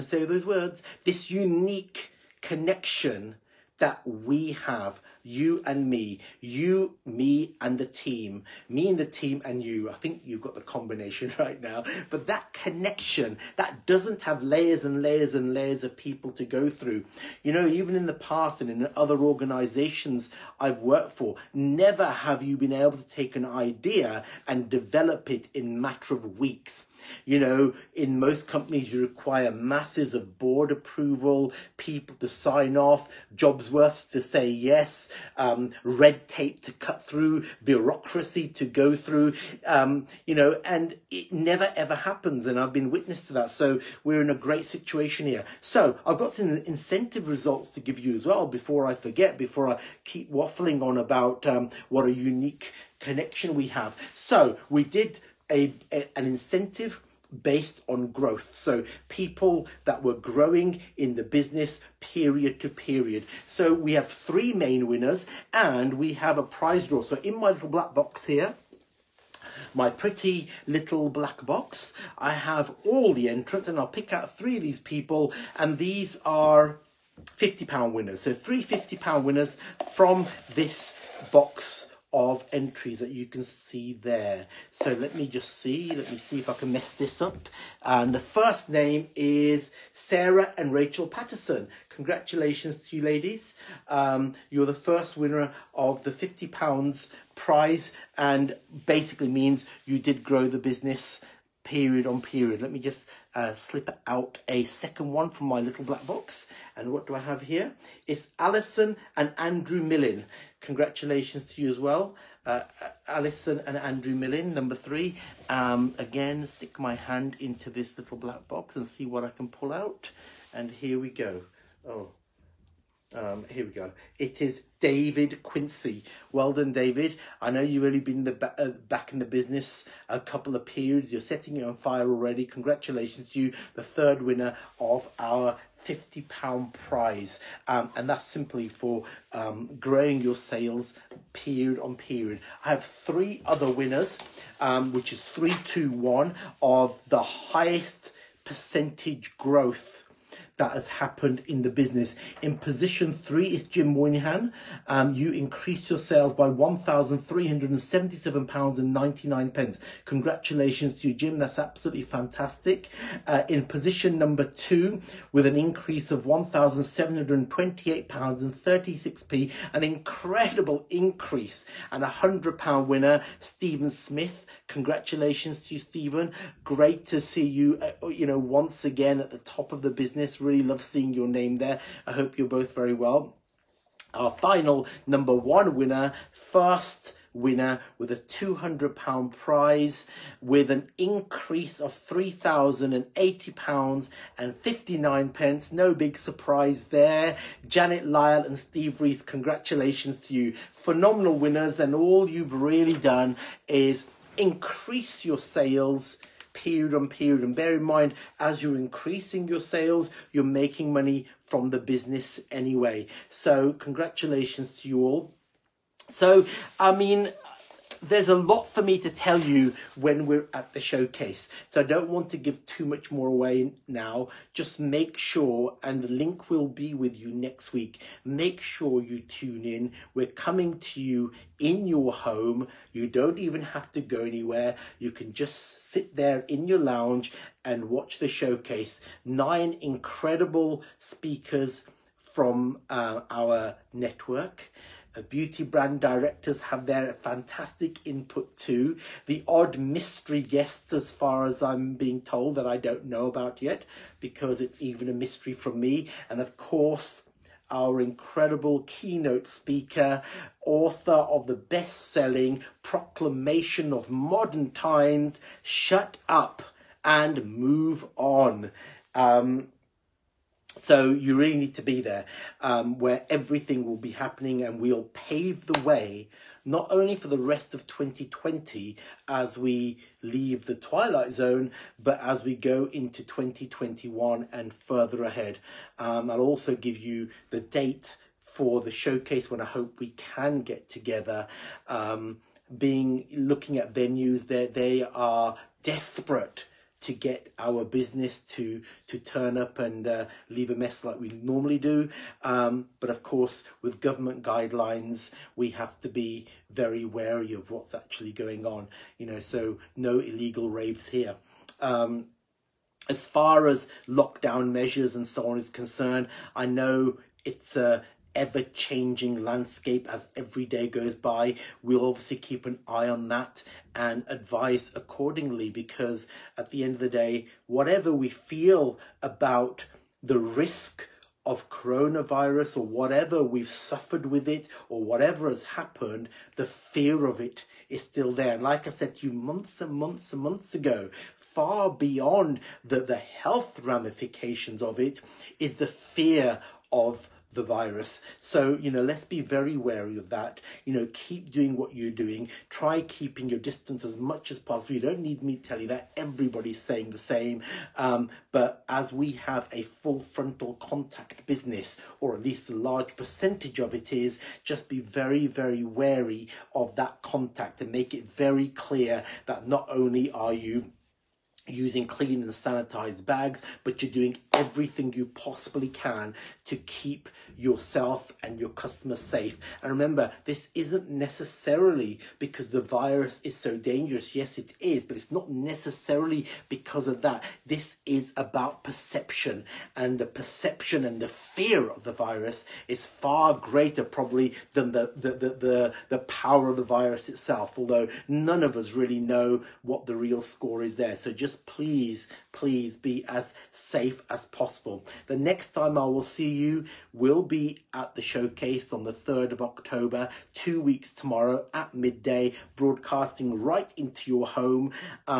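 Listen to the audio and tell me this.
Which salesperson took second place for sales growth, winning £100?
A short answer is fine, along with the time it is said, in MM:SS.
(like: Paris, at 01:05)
Stephen Smith, at 02:53.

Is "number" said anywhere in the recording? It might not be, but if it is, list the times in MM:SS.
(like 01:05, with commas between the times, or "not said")
01:54, 02:44, 03:05.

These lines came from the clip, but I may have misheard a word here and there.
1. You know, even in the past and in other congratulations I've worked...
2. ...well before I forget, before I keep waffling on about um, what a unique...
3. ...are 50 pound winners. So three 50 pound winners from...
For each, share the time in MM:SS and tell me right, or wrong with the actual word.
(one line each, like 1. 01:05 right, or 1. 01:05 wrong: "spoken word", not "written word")
1. 00:17 wrong: "organizations", not "congratulations"
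2. 00:48 right
3. 01:16 right.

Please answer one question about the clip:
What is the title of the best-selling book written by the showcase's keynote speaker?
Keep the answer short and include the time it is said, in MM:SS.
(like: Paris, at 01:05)
Shut Up and Move On, at 04:25.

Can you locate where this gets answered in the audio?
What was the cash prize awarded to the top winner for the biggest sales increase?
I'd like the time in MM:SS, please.
03:08.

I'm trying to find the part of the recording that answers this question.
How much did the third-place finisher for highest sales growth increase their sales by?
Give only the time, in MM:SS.
02:36.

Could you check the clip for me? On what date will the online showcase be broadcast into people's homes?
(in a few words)
3rd of October.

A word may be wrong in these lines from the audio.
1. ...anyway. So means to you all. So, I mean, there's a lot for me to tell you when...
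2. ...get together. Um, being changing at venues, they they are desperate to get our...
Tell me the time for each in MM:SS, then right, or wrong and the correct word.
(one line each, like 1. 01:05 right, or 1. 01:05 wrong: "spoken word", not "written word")
1. 03:32 wrong: "congratulations", not "means"
2. 04:50 wrong: "looking", not "changing".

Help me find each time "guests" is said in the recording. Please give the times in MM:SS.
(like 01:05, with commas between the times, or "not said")
04:10.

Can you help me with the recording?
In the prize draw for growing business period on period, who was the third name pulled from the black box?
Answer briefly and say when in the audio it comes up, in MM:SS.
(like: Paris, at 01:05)
David Quincy, at 02:04.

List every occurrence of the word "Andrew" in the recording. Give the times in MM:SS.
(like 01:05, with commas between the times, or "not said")
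01:49, 01:53.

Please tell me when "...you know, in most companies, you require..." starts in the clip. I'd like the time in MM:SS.
00:27.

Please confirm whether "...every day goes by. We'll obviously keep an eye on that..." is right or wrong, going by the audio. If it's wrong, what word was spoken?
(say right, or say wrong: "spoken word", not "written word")
right.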